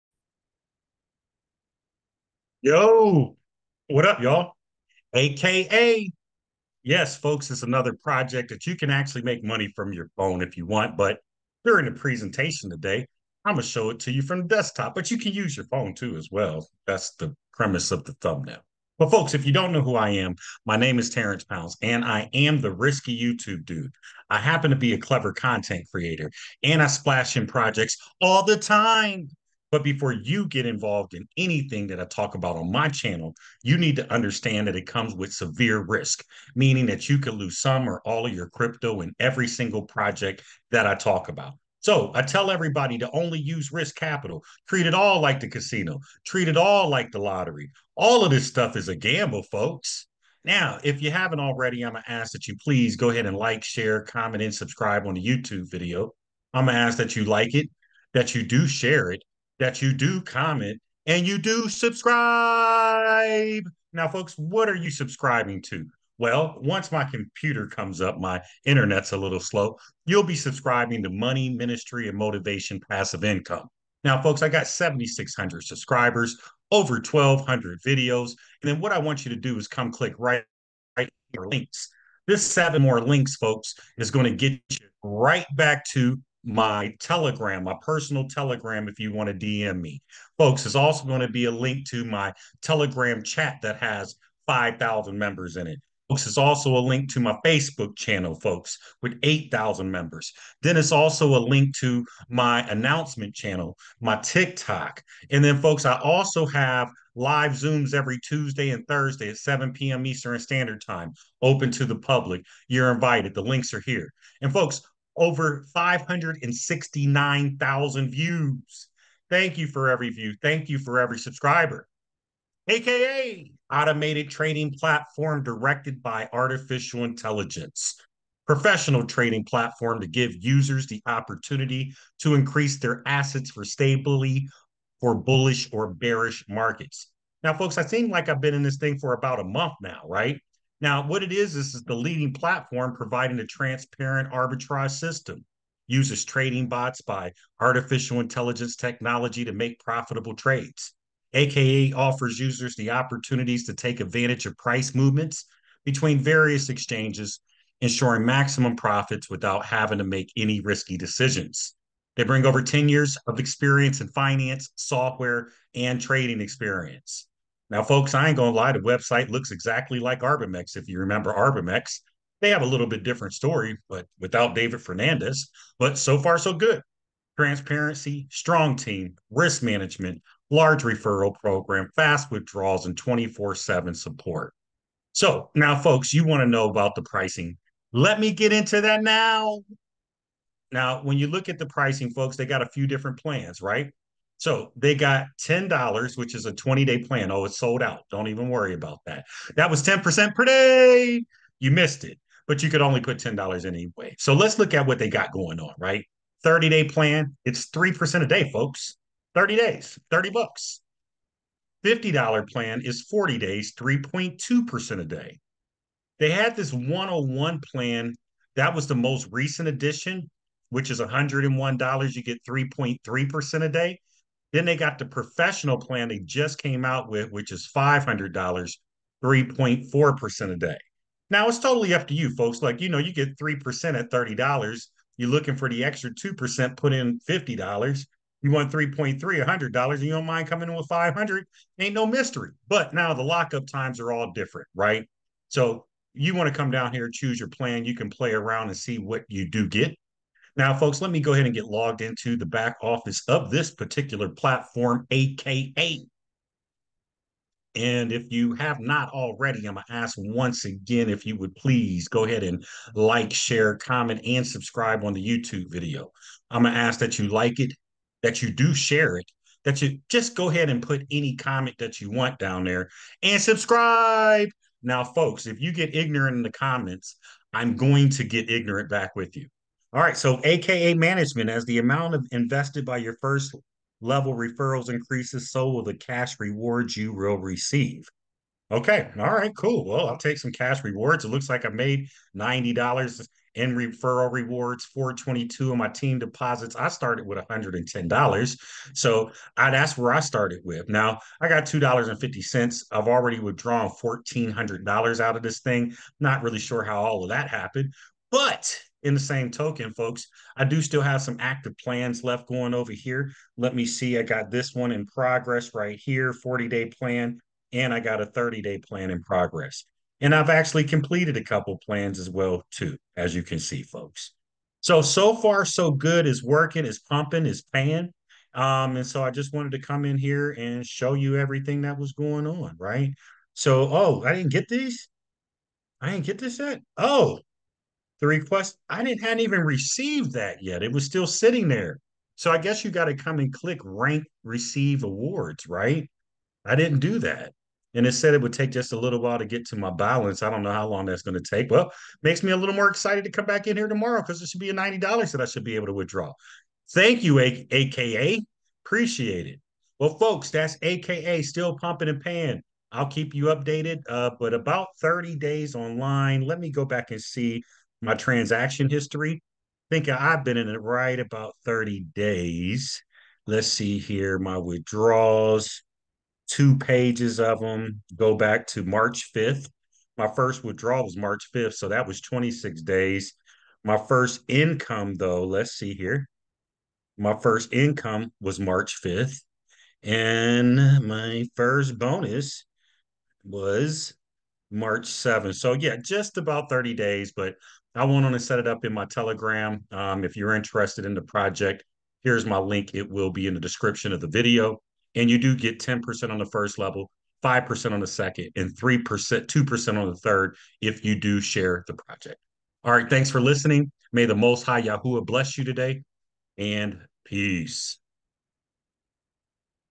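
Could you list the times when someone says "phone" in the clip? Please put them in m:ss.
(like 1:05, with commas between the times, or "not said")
0:10, 0:15.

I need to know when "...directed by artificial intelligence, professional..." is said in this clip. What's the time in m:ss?
2:05.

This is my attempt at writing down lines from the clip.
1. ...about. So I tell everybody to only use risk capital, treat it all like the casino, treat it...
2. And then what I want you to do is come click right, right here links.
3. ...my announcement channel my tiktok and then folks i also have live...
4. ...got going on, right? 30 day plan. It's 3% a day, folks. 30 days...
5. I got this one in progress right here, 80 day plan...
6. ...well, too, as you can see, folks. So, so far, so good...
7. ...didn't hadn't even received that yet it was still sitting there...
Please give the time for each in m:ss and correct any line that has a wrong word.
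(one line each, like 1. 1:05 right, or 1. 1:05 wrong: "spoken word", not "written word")
1. 0:41 right
2. 1:18 right
3. 1:42 right
4. 3:25 right
5. 5:14 wrong: "40", not "80"
6. 5:22 right
7. 5:39 right.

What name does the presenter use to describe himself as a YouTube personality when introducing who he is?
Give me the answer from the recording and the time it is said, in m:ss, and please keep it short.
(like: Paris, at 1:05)
the risky YouTube dude, at 0:22.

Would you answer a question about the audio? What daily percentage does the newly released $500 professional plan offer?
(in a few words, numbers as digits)
3.4%.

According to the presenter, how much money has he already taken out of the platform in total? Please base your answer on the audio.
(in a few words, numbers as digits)
$1,400.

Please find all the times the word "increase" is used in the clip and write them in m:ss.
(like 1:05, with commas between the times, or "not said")
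2:12, 4:44.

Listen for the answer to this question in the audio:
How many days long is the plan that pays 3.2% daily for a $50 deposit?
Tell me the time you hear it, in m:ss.
3:33.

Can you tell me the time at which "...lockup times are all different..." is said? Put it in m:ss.
4:03.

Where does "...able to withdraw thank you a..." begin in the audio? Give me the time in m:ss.
5:55.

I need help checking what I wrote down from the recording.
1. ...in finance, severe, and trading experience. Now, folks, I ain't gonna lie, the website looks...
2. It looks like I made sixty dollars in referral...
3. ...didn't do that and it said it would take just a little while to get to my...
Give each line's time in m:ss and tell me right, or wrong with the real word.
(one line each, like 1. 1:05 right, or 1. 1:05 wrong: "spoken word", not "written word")
1. 2:44 wrong: "software", not "severe"
2. 4:51 wrong: "ninety", not "sixty"
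3. 5:46 right.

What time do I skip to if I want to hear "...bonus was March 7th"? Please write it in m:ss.
6:31.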